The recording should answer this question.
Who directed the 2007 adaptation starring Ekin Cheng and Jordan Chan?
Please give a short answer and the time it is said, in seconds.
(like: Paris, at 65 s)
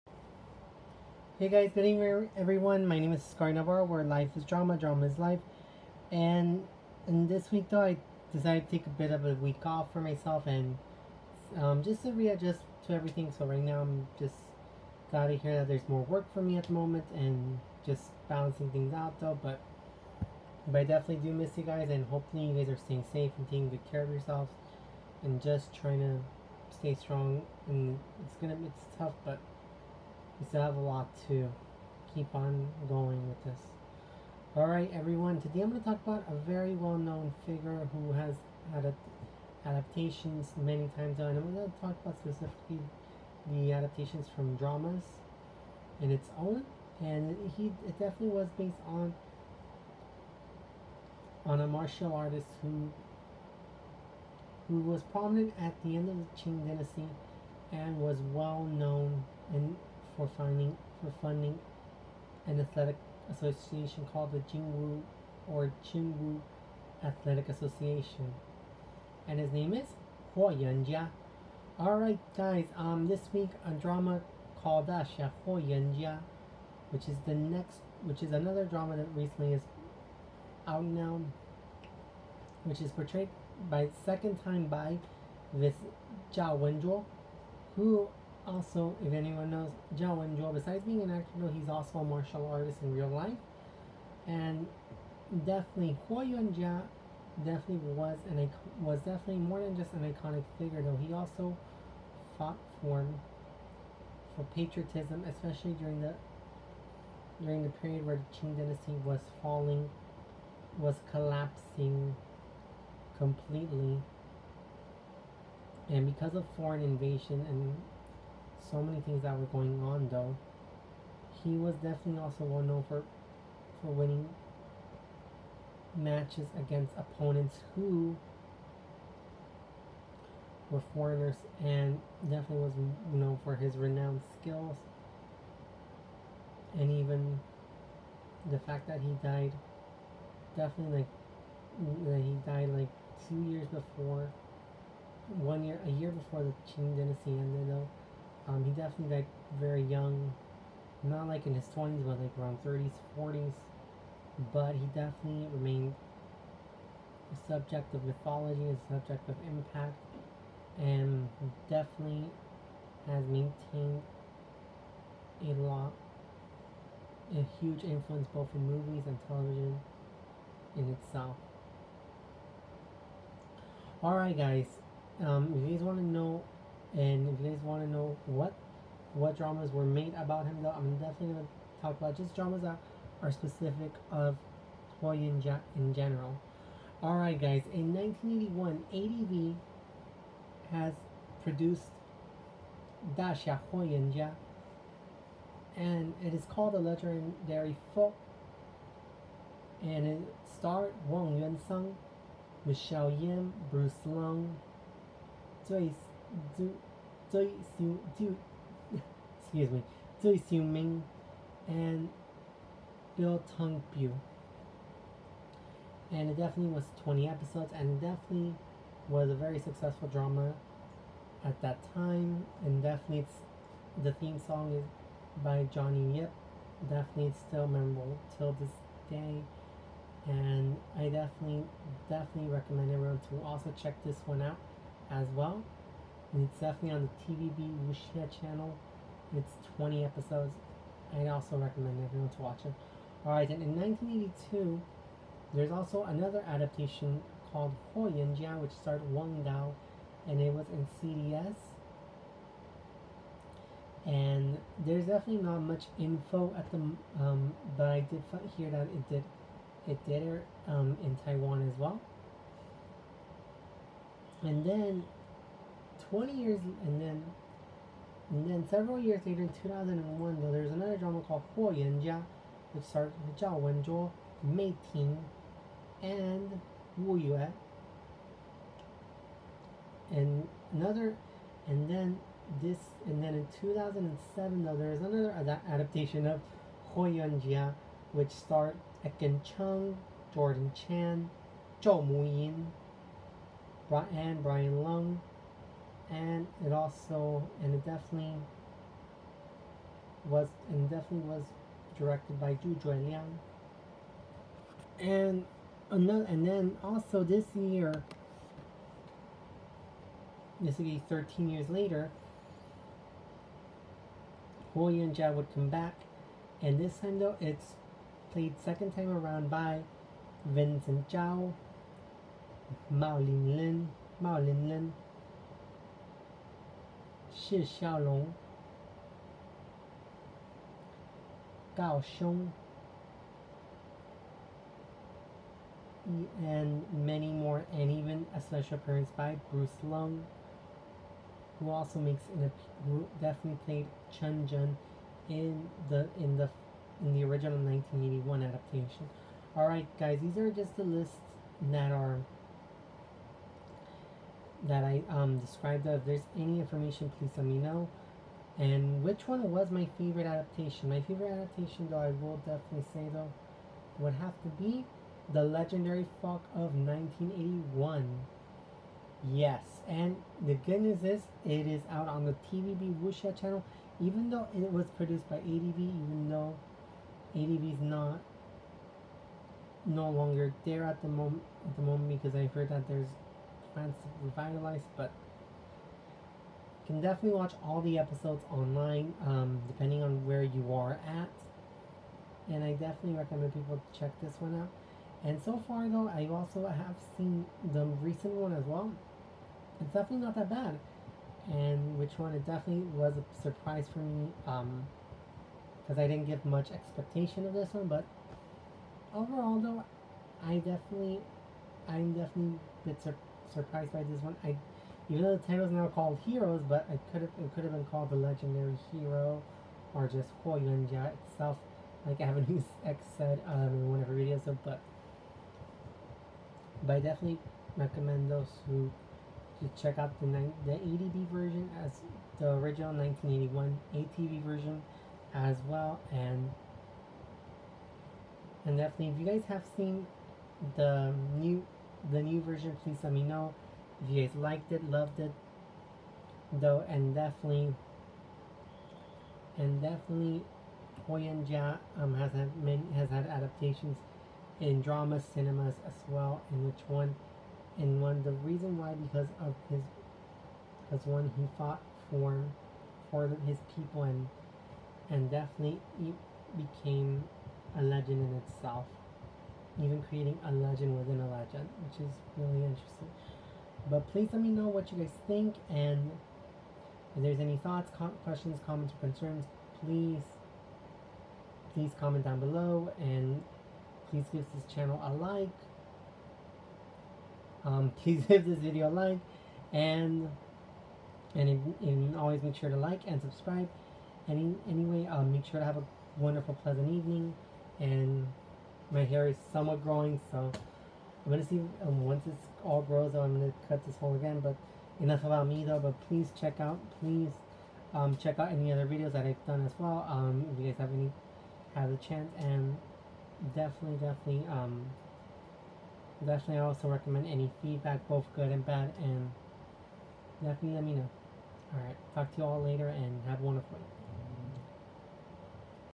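Zhu Liang, at 302 s.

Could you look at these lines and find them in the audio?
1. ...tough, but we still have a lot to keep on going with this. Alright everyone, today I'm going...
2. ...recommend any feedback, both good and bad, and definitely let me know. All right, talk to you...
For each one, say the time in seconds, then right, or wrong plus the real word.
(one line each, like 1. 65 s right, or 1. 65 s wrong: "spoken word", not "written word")
1. 28 s right
2. 516 s right.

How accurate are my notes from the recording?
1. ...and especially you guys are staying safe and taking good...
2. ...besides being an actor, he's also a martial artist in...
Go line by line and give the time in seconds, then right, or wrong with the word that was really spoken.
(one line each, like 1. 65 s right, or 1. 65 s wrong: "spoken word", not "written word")
1. 21 s wrong: "hopefully", not "especially"
2. 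90 s right.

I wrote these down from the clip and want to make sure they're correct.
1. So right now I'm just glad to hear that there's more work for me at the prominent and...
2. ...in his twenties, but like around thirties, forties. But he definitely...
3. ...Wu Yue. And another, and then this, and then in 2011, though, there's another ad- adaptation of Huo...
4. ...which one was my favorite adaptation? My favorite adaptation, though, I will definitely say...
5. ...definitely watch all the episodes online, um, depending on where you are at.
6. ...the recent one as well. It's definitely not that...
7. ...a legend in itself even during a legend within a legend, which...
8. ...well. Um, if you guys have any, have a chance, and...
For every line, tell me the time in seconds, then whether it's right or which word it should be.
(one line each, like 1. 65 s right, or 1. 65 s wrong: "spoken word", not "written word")
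1. 13 s wrong: "moment", not "prominent"
2. 151 s right
3. 276 s wrong: "2007", not "2011"
4. 359 s right
5. 387 s right
6. 397 s right
7. 467 s wrong: "creating", not "during"
8. 509 s right.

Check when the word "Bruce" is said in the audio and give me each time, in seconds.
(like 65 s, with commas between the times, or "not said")
203 s, 339 s.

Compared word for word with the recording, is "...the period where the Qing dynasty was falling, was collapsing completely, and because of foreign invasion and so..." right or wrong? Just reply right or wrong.
right.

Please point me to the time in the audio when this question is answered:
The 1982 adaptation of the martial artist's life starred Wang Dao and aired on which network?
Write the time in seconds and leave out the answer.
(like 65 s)
251 s.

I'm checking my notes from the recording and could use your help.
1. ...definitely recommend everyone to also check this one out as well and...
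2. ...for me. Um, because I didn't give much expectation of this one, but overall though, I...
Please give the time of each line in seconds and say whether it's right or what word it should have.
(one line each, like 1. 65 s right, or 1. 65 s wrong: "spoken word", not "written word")
1. 232 s right
2. 403 s right.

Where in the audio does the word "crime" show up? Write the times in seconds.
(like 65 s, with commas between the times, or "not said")
not said.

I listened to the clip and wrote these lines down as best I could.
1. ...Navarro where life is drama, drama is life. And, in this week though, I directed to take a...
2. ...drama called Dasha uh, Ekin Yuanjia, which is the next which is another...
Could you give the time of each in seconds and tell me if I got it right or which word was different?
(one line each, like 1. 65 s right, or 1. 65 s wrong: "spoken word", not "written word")
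1. 3 s wrong: "decided", not "directed"
2. 73 s wrong: "Huo", not "Ekin".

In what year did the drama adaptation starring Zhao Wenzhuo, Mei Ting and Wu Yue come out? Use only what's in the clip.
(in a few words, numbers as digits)
2001.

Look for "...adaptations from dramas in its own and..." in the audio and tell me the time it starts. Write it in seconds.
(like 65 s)
43 s.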